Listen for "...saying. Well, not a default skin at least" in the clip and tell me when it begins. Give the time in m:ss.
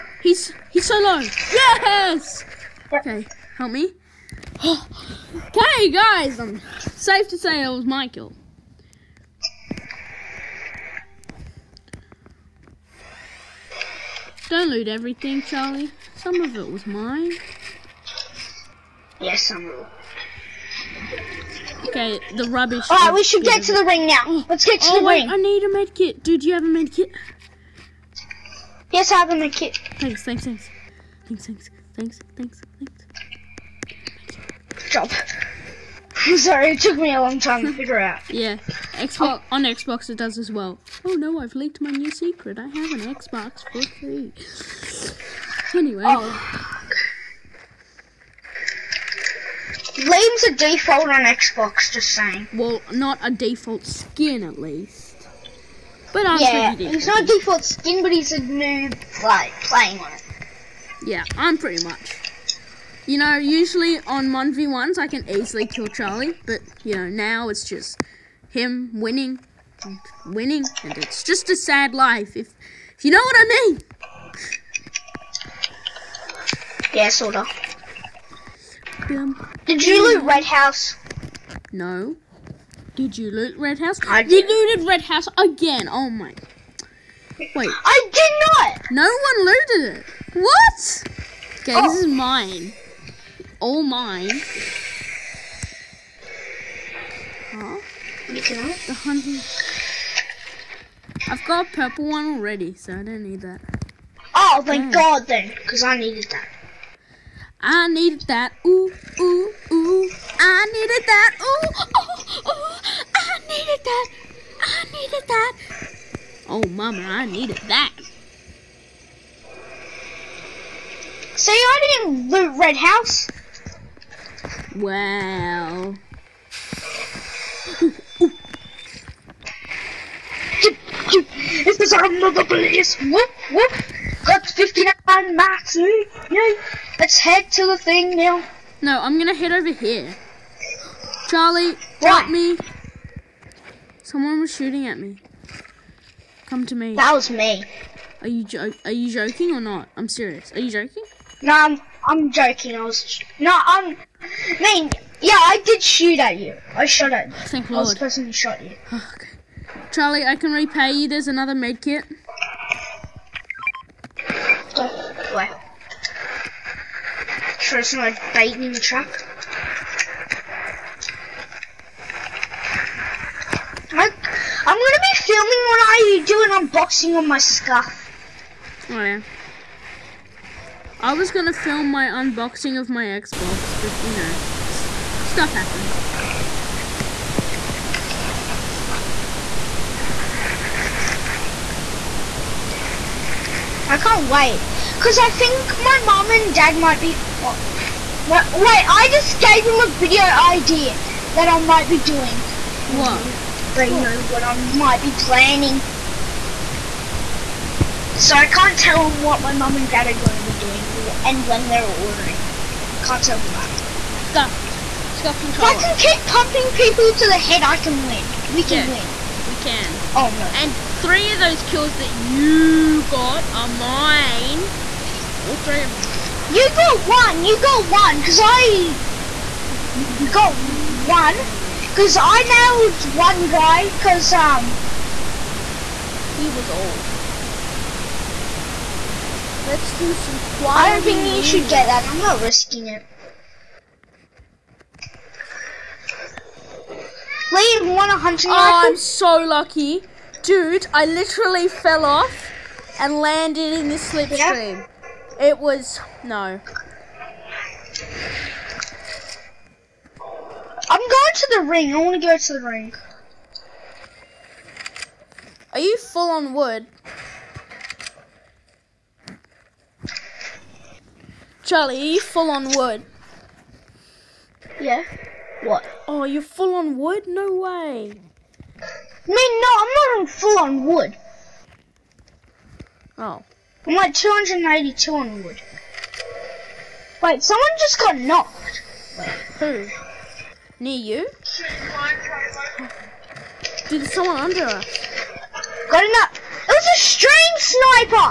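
0:52.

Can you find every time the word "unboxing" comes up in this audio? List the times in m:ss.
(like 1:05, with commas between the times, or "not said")
2:56, 3:02.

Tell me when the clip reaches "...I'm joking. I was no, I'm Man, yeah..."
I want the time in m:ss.
2:32.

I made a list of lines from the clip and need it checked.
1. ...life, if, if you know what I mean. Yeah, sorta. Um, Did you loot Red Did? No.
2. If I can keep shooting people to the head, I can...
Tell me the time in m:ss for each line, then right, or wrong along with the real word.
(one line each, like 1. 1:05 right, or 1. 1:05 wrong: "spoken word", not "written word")
1. 1:11 wrong: "House", not "Did"
2. 3:35 wrong: "pumping", not "shooting".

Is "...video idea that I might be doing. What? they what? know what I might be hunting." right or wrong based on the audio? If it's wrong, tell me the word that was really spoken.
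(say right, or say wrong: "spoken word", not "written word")
wrong: "planning", not "hunting".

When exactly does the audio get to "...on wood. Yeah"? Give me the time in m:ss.
4:32.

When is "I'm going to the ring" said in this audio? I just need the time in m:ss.
4:20.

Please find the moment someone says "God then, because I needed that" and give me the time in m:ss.
1:44.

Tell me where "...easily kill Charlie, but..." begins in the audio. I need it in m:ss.
1:05.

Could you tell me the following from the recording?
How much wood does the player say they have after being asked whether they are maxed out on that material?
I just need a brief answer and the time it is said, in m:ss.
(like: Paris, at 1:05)
282, at 4:44.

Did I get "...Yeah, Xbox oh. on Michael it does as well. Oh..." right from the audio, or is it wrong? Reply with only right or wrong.
wrong.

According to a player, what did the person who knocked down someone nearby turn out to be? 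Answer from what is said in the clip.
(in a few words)
A stream sniper.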